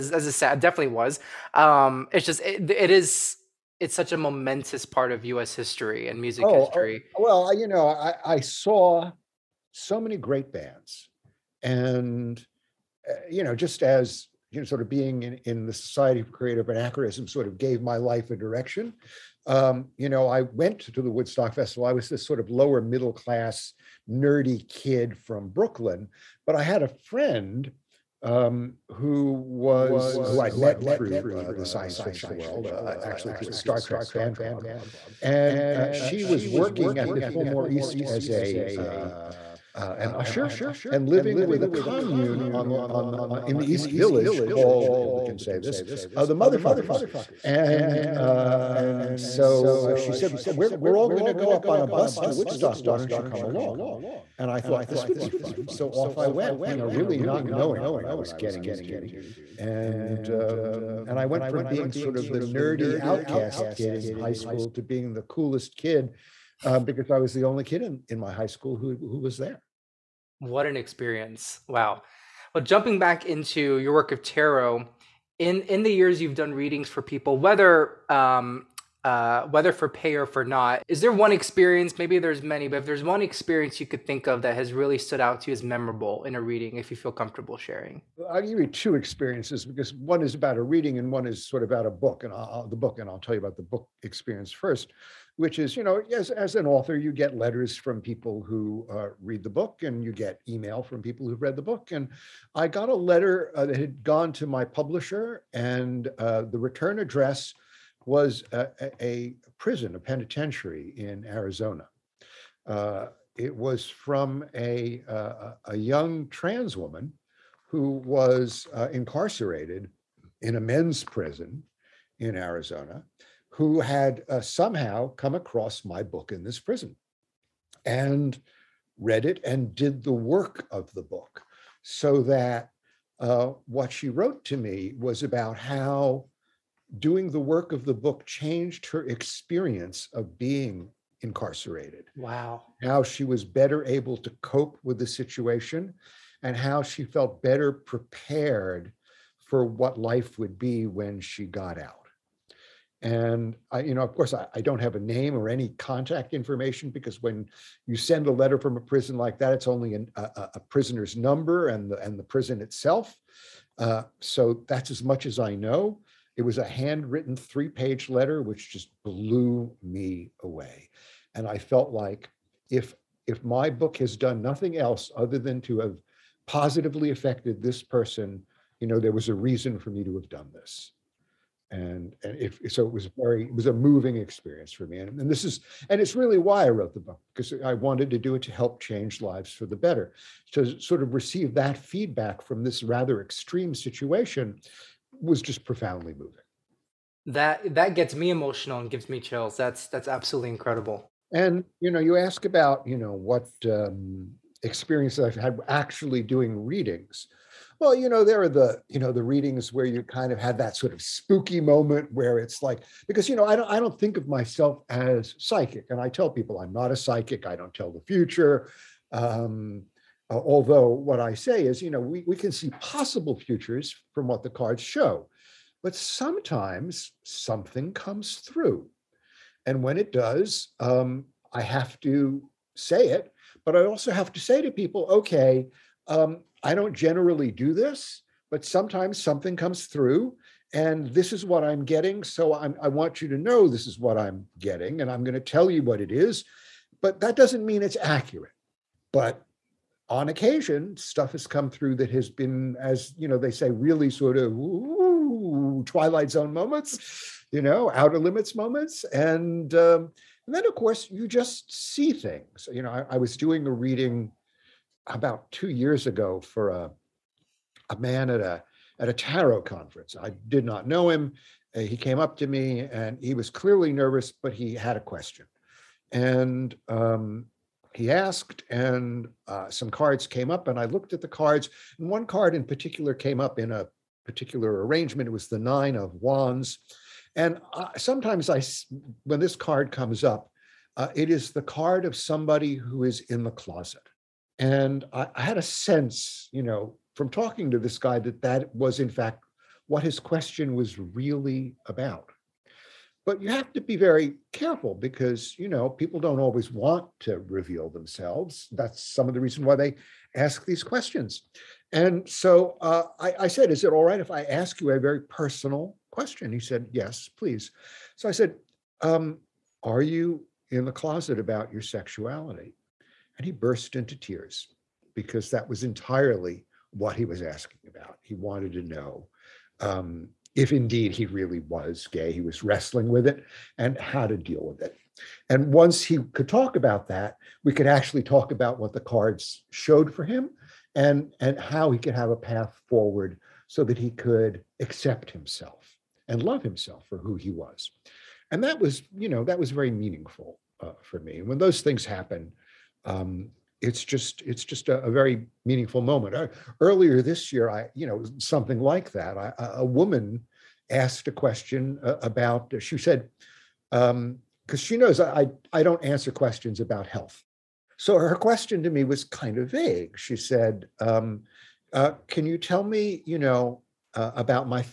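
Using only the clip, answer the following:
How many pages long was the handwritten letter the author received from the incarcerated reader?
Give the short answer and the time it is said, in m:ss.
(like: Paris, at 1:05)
3, at 2:47.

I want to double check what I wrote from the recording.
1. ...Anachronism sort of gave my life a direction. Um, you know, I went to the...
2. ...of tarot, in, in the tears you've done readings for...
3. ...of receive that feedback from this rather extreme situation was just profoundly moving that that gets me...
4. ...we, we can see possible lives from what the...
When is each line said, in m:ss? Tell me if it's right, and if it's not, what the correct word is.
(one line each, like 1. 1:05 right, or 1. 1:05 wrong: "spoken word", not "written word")
1. 0:16 right
2. 1:14 wrong: "years", not "tears"
3. 3:11 right
4. 3:41 wrong: "futures", not "lives".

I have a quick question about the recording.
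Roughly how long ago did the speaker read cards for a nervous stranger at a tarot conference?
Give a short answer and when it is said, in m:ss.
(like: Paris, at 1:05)
2 years, at 4:25.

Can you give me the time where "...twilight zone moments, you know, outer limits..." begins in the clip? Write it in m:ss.
4:15.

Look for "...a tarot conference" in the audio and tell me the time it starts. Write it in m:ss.
4:29.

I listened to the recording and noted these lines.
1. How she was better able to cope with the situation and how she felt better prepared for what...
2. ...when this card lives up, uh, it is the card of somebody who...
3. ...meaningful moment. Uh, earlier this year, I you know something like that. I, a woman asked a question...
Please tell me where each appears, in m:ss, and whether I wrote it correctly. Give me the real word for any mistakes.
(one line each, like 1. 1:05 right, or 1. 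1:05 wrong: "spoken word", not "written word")
1. 2:22 right
2. 4:49 wrong: "comes", not "lives"
3. 5:55 right.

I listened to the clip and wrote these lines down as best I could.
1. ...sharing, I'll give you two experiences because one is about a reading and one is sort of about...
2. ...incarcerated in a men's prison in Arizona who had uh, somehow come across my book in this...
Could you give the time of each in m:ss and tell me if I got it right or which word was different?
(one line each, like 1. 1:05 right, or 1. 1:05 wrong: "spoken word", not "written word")
1. 1:27 right
2. 1:58 right.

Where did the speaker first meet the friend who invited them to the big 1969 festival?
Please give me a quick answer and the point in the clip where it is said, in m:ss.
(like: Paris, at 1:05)
Star Trek fan club, at 0:33.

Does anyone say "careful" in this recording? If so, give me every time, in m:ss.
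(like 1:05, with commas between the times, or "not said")
5:04.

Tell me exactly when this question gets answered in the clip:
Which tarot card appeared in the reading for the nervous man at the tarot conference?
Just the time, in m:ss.
4:45.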